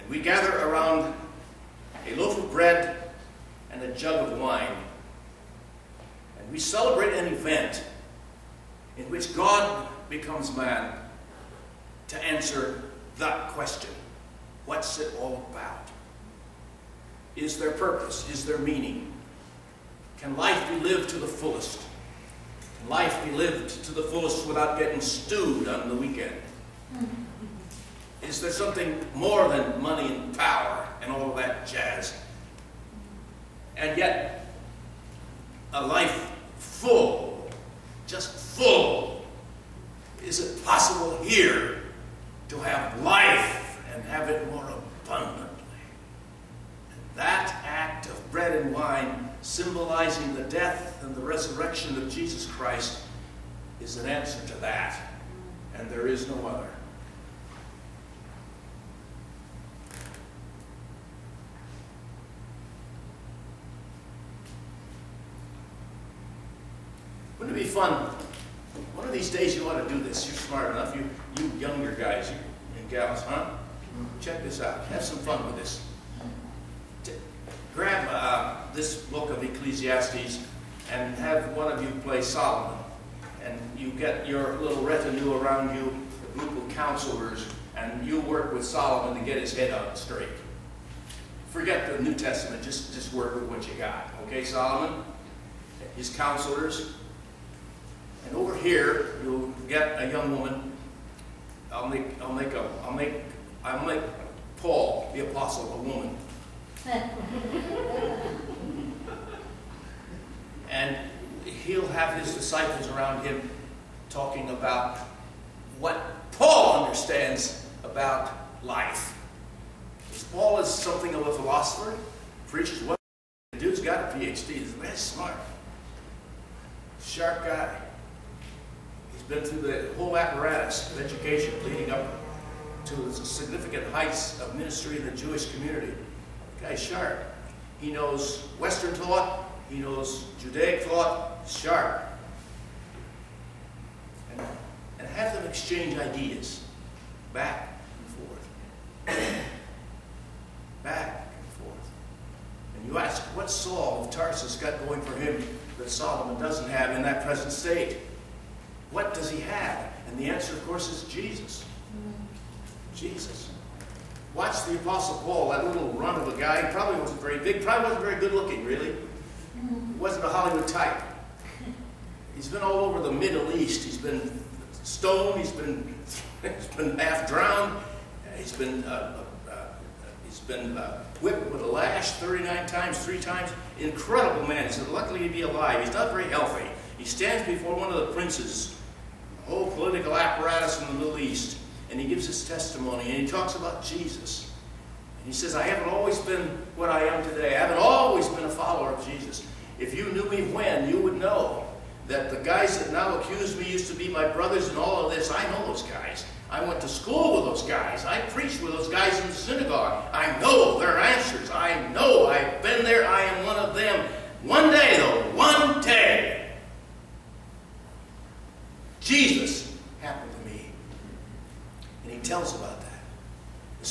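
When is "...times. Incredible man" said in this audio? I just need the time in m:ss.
3:03.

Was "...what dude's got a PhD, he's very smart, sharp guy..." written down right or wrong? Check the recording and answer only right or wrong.
right.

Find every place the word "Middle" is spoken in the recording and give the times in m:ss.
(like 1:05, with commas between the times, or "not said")
2:53, 3:10.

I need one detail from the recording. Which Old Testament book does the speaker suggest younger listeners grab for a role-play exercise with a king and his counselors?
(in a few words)
Ecclesiastes.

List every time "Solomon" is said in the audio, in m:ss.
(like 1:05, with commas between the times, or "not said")
1:22, 1:28, 1:34, 2:35.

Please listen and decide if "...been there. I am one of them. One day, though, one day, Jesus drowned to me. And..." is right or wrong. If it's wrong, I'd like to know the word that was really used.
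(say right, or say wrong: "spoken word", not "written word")
wrong: "happened", not "drowned".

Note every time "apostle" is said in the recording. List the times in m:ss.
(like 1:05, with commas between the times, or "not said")
1:45, 2:44.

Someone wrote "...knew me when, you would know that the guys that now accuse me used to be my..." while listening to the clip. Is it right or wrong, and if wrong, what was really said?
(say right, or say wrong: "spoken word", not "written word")
right.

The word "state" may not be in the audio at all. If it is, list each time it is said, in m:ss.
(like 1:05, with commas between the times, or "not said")
2:37.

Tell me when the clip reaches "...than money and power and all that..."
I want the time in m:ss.
0:29.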